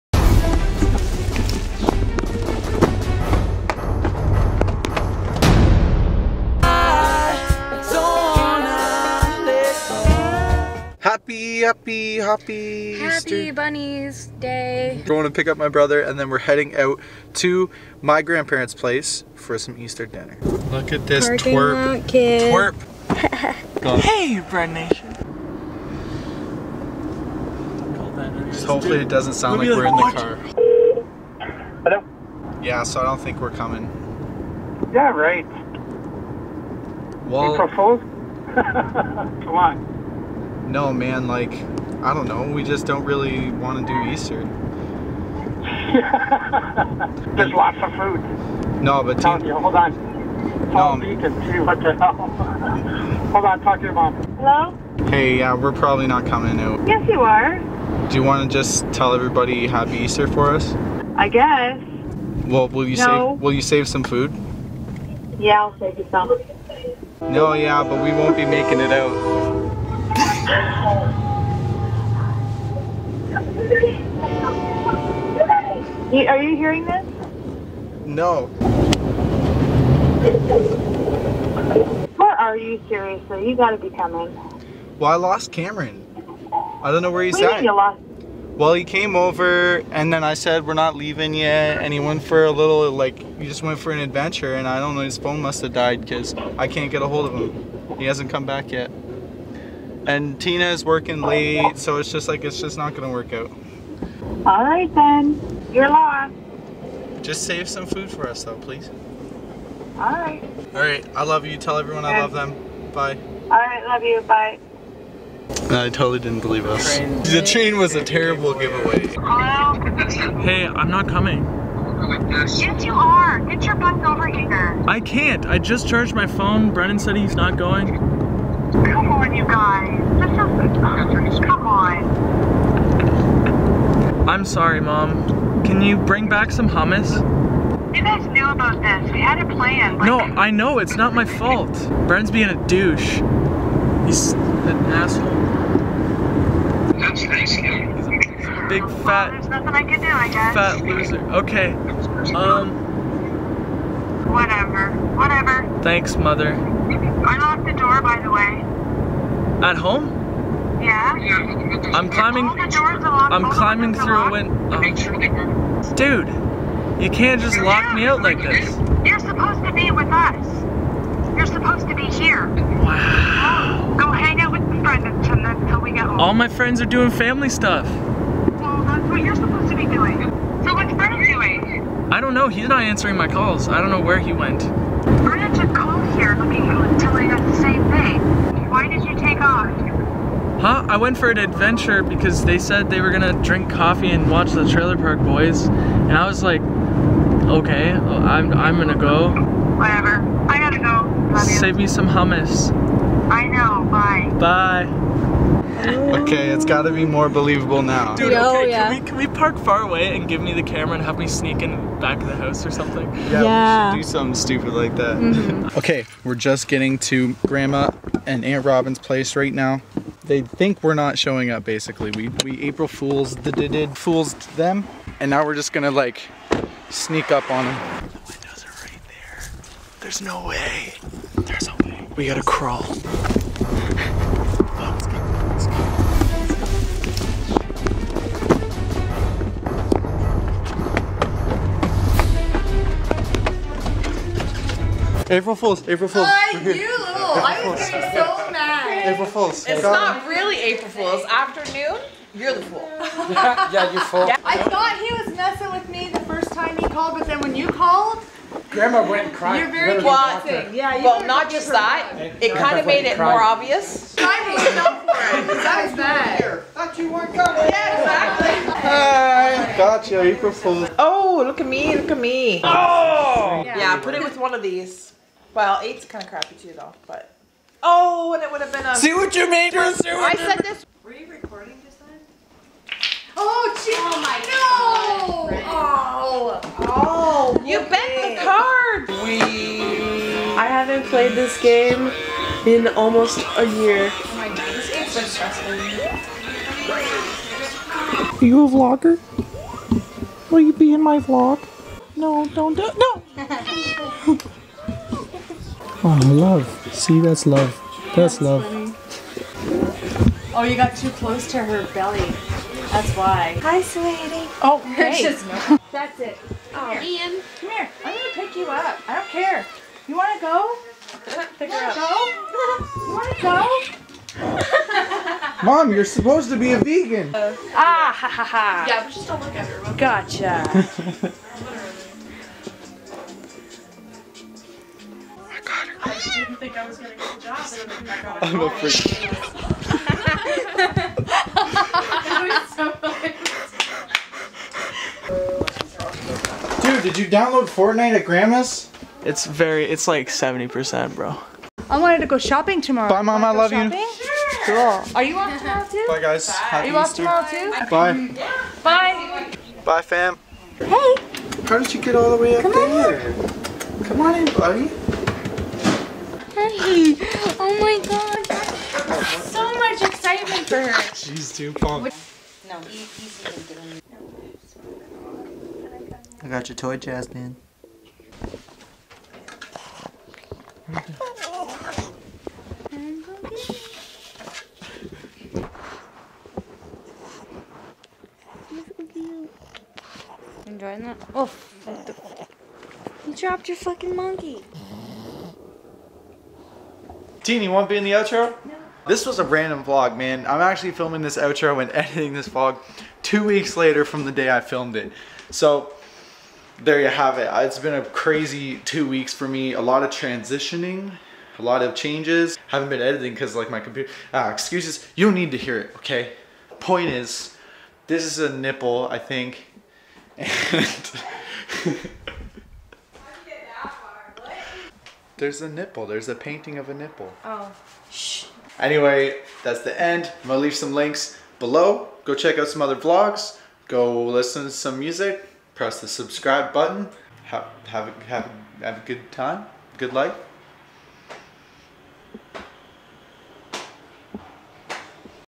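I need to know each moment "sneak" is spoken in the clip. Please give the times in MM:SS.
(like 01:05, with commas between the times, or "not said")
03:31, 03:46.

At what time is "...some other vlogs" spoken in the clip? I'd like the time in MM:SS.
07:12.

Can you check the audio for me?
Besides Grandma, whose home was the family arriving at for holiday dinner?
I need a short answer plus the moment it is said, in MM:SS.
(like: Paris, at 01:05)
Aunt Robin, at 03:38.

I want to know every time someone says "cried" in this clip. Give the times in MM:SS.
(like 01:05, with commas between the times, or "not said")
04:23.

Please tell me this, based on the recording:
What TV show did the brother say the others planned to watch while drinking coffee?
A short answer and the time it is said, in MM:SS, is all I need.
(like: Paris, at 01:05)
Trailer Park Boys, at 03:14.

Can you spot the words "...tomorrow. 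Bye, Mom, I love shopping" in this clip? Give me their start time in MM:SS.
05:52.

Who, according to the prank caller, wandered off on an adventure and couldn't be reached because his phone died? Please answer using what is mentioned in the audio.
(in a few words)
Cameron.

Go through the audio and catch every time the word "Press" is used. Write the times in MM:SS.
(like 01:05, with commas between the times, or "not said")
07:15.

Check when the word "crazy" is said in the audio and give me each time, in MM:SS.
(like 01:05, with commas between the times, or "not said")
06:48.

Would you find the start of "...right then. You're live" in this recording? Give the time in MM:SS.
01:44.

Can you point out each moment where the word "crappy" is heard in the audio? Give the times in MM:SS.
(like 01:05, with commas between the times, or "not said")
04:36.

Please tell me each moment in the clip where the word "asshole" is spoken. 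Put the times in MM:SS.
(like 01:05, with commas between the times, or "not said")
02:24.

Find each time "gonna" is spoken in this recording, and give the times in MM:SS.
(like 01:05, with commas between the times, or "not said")
01:42, 03:13, 03:18, 03:45, 07:10.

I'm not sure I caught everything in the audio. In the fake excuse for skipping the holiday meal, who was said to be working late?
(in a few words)
Tina.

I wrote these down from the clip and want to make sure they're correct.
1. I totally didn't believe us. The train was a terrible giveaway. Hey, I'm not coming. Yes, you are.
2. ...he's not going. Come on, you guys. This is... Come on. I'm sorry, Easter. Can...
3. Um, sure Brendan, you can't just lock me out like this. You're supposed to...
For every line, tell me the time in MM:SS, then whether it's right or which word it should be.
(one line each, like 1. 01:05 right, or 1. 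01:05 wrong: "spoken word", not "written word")
1. 01:55 right
2. 02:07 wrong: "Mom", not "Easter"
3. 02:44 wrong: "Dude", not "Brendan".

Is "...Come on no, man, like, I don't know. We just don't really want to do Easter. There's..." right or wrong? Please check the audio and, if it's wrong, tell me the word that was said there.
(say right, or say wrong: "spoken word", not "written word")
right.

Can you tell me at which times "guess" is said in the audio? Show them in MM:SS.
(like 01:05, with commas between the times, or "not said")
01:01, 02:30.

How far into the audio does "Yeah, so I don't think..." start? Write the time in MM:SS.
00:32.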